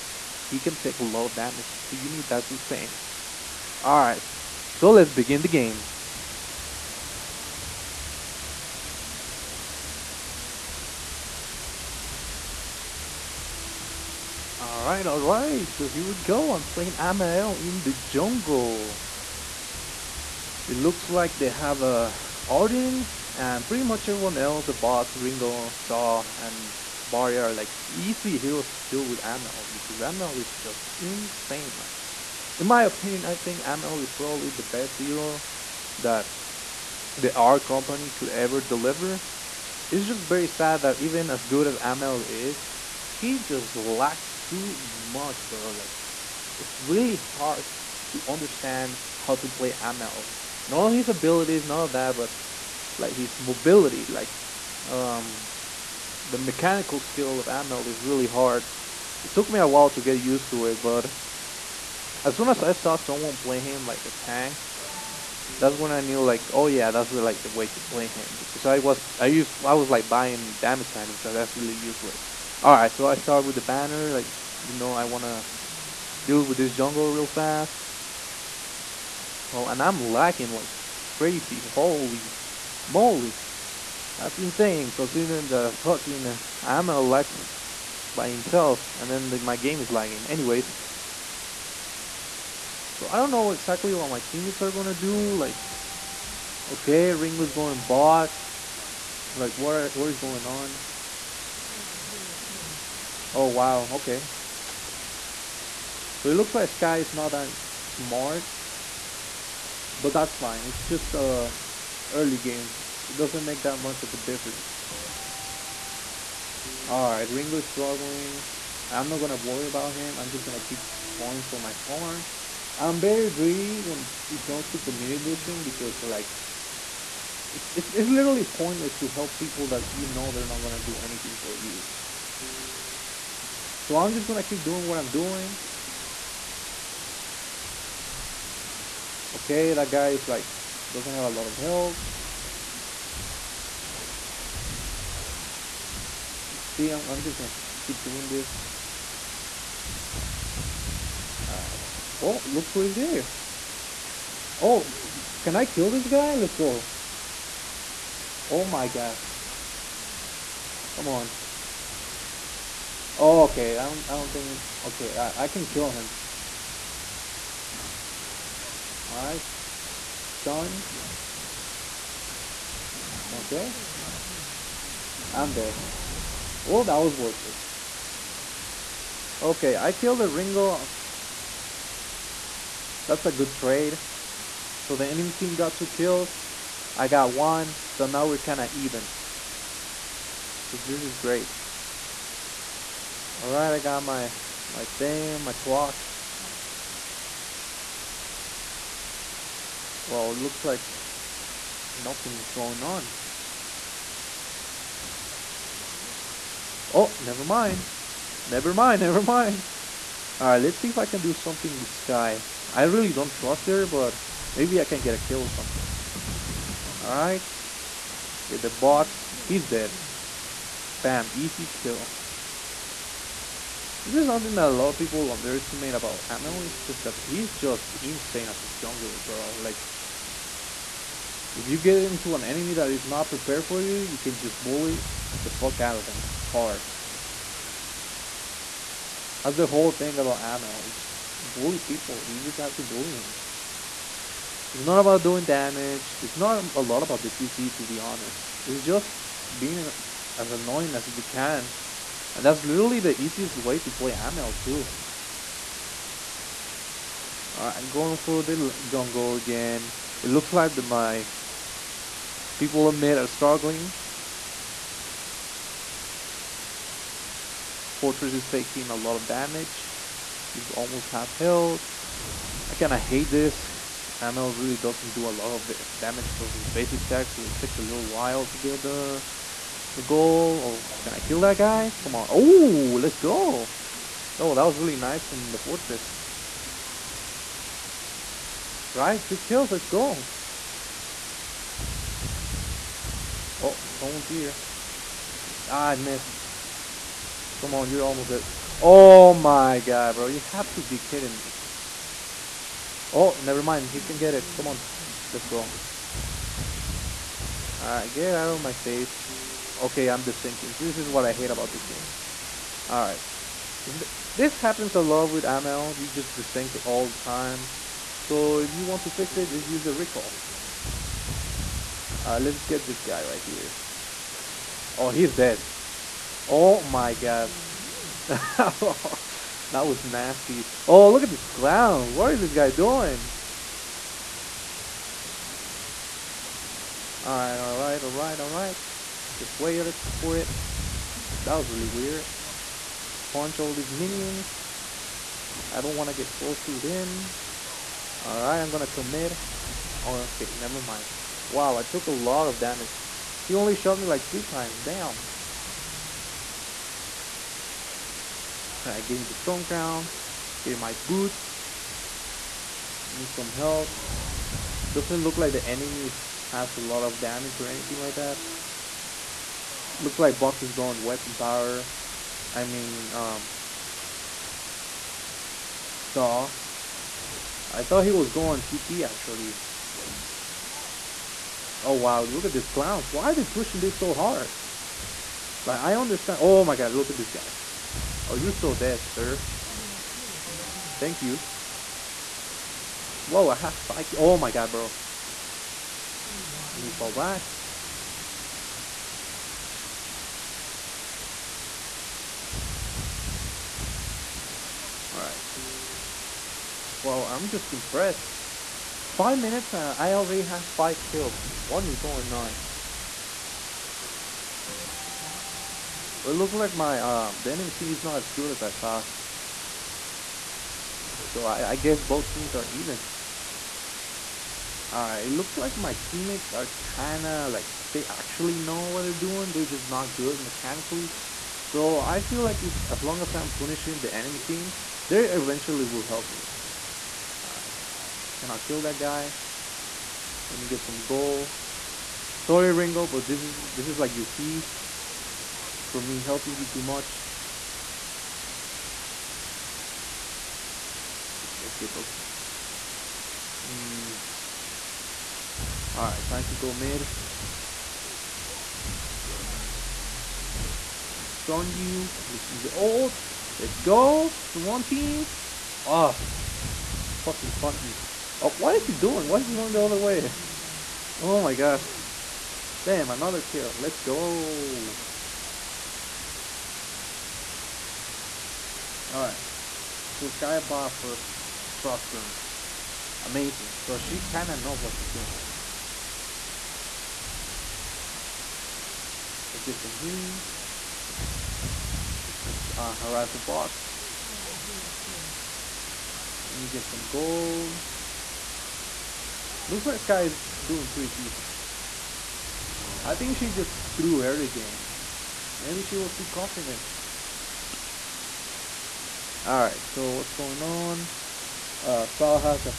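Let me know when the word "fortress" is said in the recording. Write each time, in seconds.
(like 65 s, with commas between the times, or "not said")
267 s, 285 s.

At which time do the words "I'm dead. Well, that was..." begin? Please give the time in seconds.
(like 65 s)
175 s.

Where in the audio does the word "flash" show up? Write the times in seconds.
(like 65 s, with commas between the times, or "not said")
not said.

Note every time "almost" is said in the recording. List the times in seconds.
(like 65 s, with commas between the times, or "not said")
270 s, 298 s.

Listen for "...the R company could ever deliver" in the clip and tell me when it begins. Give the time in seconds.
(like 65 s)
37 s.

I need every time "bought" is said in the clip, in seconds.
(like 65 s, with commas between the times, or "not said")
480 s.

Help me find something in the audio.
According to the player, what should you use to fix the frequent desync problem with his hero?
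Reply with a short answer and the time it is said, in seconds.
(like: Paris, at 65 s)
Recall, at 319 s.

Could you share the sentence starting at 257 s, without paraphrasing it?
Alright, I'm going for the jungle again.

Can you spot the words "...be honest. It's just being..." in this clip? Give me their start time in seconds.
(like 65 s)
247 s.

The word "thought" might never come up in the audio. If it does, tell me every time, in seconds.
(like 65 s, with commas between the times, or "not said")
377 s, 418 s.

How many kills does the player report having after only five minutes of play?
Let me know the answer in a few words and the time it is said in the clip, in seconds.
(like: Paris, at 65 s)
5, at 410 s.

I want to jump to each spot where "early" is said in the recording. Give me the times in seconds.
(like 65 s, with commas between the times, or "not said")
112 s, 504 s.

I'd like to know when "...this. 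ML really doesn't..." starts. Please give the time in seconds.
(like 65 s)
273 s.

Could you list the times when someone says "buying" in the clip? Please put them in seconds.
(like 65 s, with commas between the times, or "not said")
70 s.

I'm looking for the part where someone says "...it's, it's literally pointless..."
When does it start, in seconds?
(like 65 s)
127 s.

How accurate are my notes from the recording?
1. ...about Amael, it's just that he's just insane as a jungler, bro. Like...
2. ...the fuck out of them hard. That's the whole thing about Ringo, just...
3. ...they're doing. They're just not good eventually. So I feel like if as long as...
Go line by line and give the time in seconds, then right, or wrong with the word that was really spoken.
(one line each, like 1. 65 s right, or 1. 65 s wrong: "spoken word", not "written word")
1. 225 s right
2. 235 s wrong: "Amael", not "Ringo"
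3. 429 s wrong: "mechanically", not "eventually".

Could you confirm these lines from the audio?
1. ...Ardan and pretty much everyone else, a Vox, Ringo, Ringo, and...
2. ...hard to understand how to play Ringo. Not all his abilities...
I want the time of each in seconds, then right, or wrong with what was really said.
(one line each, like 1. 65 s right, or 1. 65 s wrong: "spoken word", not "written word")
1. 22 s wrong: "Saw", not "Ringo"
2. 47 s wrong: "Amael", not "Ringo".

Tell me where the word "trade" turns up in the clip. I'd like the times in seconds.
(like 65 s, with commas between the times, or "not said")
183 s.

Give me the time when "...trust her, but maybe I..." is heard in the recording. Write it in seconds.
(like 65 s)
213 s.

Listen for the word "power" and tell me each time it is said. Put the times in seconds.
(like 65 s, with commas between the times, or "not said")
371 s.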